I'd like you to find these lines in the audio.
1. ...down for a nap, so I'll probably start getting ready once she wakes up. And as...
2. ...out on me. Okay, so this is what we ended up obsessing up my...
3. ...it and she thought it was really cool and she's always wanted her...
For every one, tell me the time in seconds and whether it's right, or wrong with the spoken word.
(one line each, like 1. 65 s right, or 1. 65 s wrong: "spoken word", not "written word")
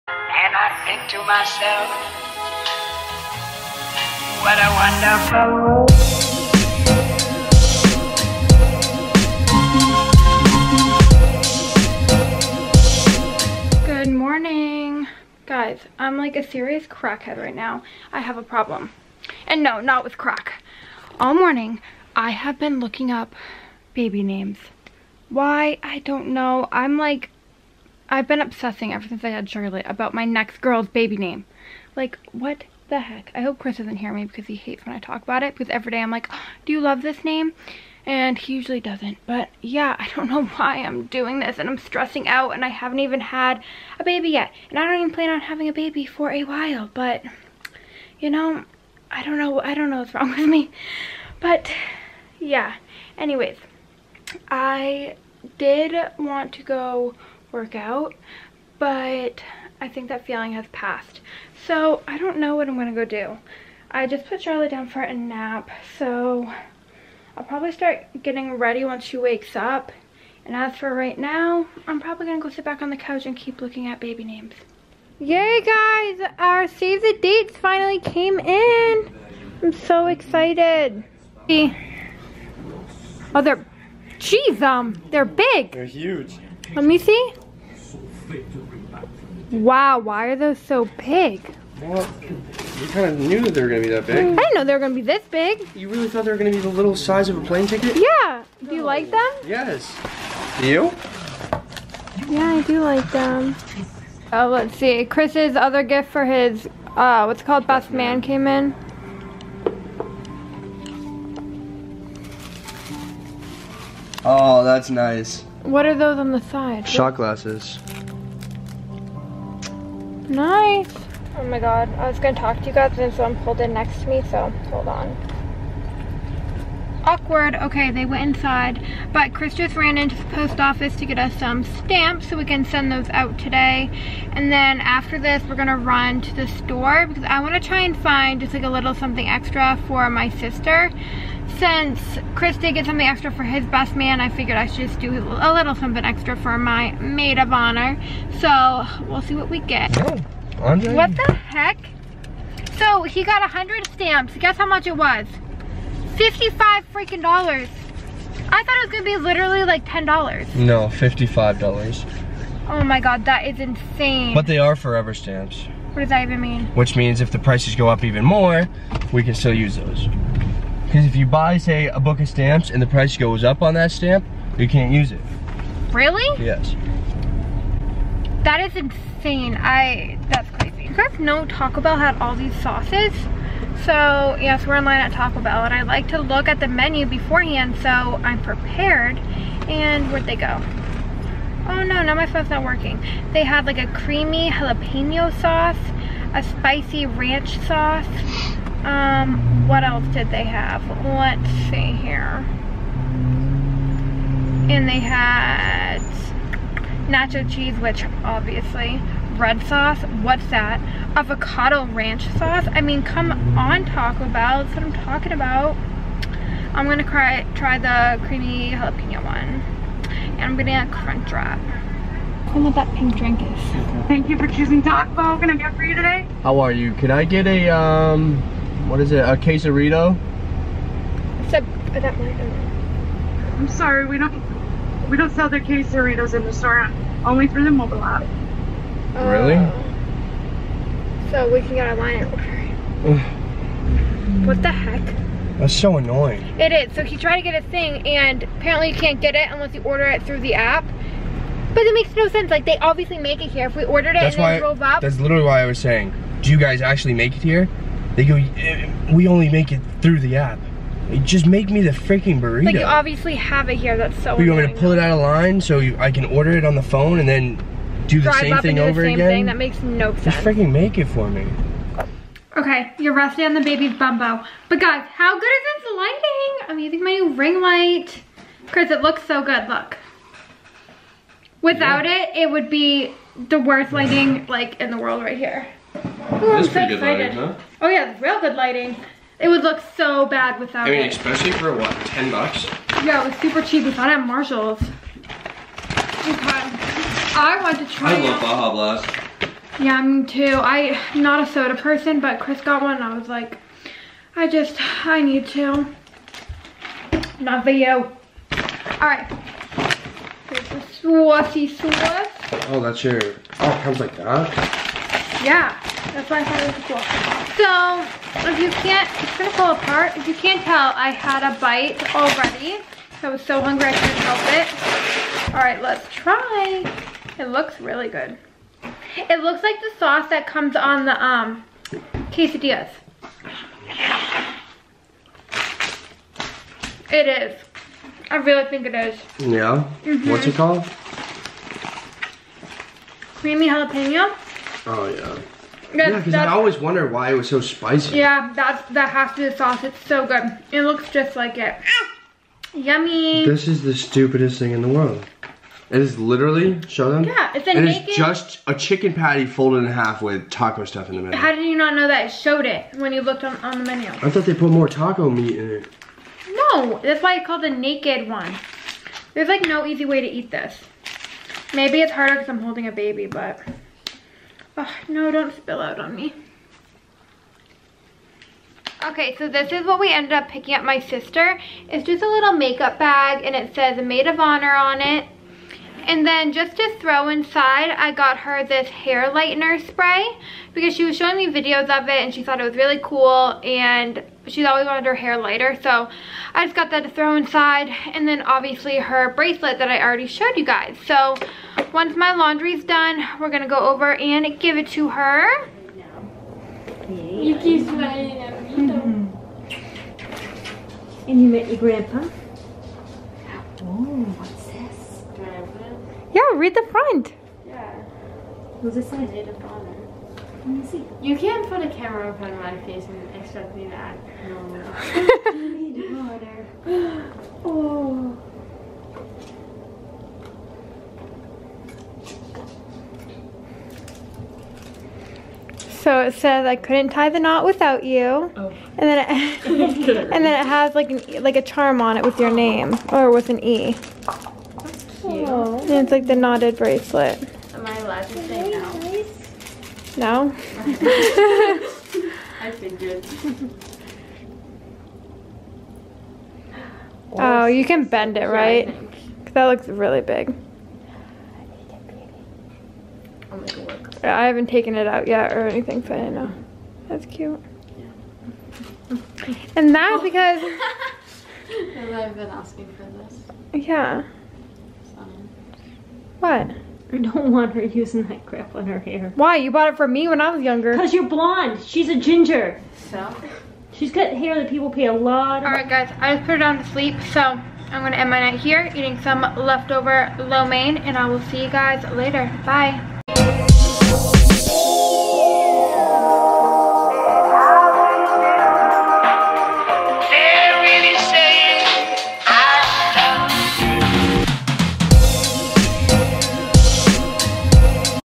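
1. 64 s right
2. 375 s wrong: "picking", not "obsessing"
3. 392 s right.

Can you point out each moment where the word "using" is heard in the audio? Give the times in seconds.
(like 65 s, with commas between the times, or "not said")
276 s, 477 s.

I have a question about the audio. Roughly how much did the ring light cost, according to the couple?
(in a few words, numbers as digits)
$10.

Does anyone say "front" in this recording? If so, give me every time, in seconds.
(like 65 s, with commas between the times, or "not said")
416 s, 422 s.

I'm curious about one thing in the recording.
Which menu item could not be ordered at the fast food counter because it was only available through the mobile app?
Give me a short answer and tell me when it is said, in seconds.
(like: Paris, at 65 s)
quesarito, at 229 s.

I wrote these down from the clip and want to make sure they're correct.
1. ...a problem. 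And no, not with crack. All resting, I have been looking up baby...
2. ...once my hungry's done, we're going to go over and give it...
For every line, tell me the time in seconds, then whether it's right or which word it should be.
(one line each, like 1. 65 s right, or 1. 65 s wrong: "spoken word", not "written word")
1. 18 s wrong: "morning", not "resting"
2. 401 s wrong: "laundry", not "hungry".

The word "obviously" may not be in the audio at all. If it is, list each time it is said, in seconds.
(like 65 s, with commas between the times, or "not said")
208 s, 252 s, 262 s, 398 s.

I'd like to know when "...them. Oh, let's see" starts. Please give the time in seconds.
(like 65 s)
103 s.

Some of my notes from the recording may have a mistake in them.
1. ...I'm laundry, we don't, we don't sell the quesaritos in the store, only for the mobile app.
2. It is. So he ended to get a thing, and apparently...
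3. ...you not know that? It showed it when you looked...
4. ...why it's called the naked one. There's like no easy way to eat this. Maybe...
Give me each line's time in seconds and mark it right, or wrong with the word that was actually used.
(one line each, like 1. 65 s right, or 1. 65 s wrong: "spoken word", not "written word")
1. 233 s wrong: "sorry", not "laundry"
2. 246 s wrong: "tried", not "ended"
3. 361 s right
4. 367 s right.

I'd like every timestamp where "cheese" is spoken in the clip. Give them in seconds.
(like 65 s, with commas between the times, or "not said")
207 s.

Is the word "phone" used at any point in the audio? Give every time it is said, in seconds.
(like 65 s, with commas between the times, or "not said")
192 s, 266 s.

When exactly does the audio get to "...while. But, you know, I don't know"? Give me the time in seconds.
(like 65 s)
46 s.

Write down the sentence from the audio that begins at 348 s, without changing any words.
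Yeah, that's that has to be the sauce.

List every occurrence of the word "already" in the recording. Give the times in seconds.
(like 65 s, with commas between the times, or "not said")
322 s, 400 s.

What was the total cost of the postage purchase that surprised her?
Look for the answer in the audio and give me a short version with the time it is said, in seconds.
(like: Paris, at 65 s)
$55, at 156 s.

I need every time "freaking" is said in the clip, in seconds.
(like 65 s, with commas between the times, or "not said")
156 s, 261 s, 270 s.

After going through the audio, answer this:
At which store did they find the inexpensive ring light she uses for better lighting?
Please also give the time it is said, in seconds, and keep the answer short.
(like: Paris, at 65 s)
Marshall's, at 294 s.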